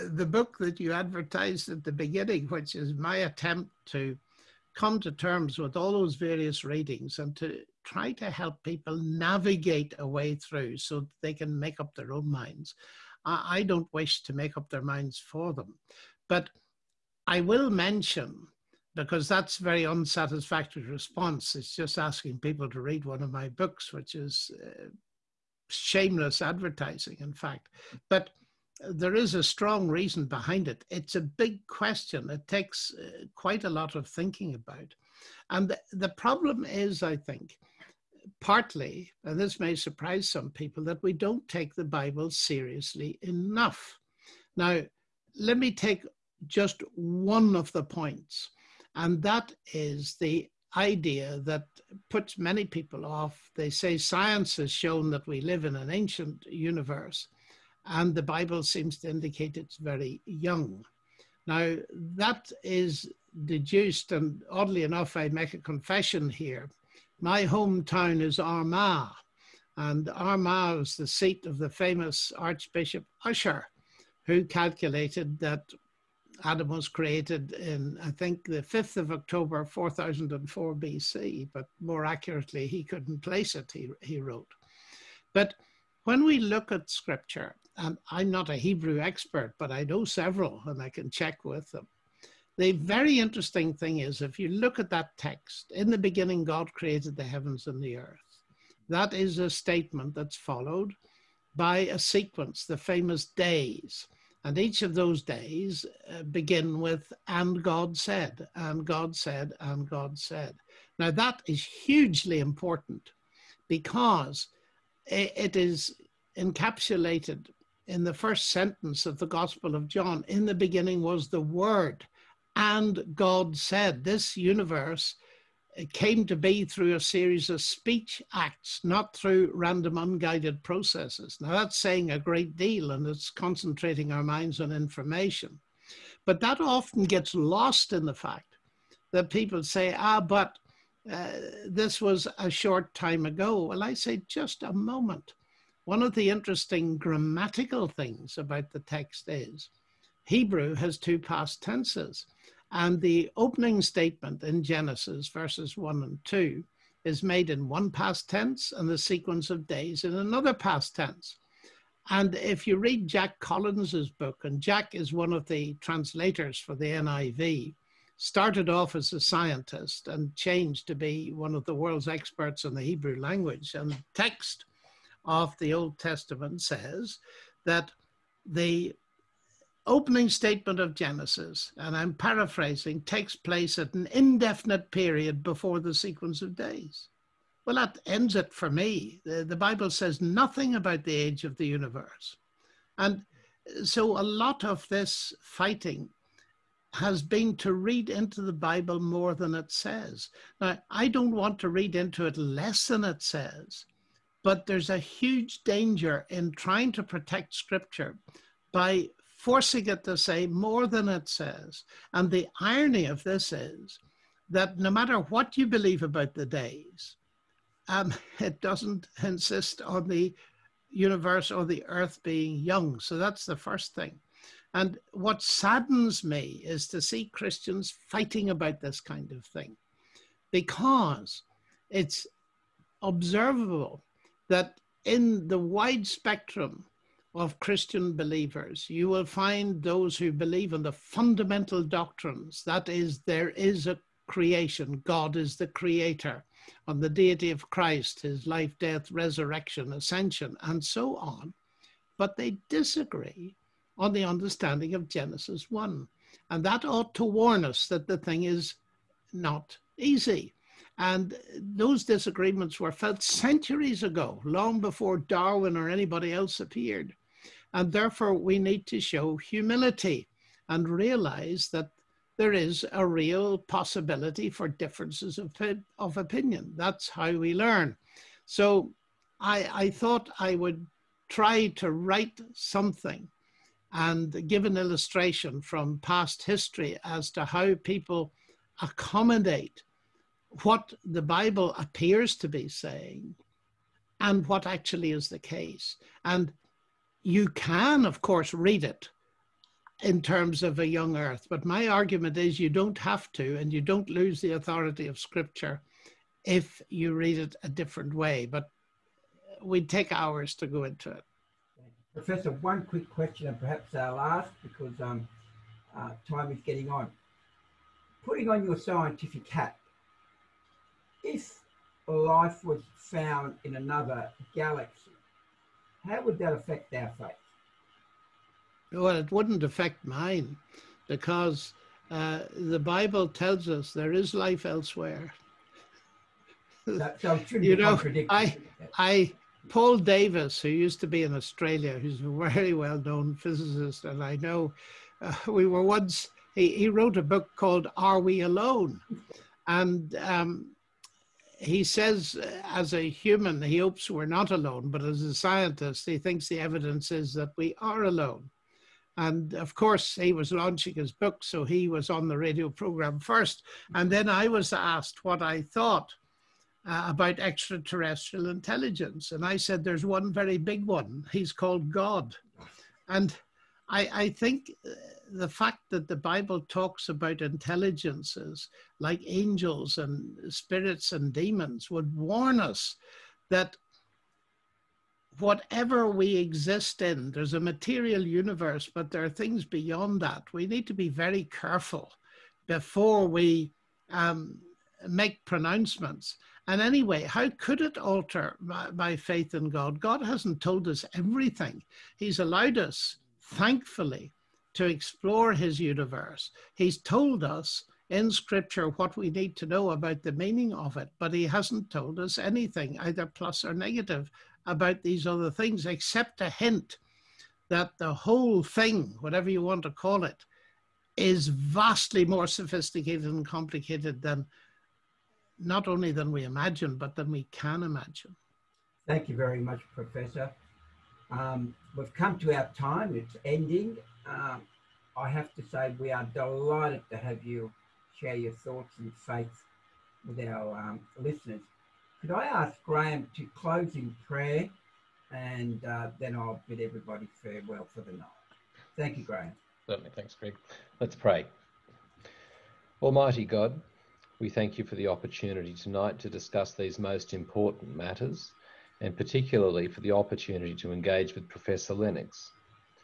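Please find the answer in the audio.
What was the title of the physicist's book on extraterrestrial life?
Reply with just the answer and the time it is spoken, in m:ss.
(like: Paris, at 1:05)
Are We Alone, at 5:47.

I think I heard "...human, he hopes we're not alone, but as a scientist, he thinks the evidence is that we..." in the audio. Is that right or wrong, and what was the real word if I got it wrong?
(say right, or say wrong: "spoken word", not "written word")
right.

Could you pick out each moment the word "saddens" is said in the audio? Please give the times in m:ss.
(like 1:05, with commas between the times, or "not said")
3:45.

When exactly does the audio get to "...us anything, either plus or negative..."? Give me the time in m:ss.
6:52.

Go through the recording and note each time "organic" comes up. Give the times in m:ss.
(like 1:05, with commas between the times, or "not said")
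not said.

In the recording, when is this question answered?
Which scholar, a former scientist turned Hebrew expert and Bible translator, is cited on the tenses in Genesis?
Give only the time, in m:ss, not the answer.
2:43.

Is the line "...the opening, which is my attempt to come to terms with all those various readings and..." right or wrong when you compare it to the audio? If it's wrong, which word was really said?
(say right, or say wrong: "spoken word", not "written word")
wrong: "beginning", not "opening".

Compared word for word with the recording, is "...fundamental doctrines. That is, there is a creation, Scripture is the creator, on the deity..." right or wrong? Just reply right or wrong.
wrong.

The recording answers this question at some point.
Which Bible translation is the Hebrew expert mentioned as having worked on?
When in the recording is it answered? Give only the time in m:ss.
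2:46.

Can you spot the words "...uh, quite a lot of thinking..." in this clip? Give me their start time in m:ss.
0:32.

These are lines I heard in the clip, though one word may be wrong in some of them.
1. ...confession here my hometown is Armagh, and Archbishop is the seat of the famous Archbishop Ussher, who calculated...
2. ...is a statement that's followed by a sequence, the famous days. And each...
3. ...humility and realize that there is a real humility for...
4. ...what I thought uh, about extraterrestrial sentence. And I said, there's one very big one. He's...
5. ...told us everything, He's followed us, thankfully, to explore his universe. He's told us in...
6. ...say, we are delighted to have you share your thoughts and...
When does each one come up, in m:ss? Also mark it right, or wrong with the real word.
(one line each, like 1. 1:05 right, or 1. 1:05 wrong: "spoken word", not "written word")
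1. 1:05 wrong: "Armagh", not "Archbishop"
2. 1:39 right
3. 4:29 wrong: "possibility", not "humility"
4. 6:05 wrong: "intelligence", not "sentence"
5. 6:40 wrong: "allowed", not "followed"
6. 7:15 right.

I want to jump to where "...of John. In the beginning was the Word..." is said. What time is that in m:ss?
1:59.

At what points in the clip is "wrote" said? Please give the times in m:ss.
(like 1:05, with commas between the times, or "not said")
1:24, 5:46.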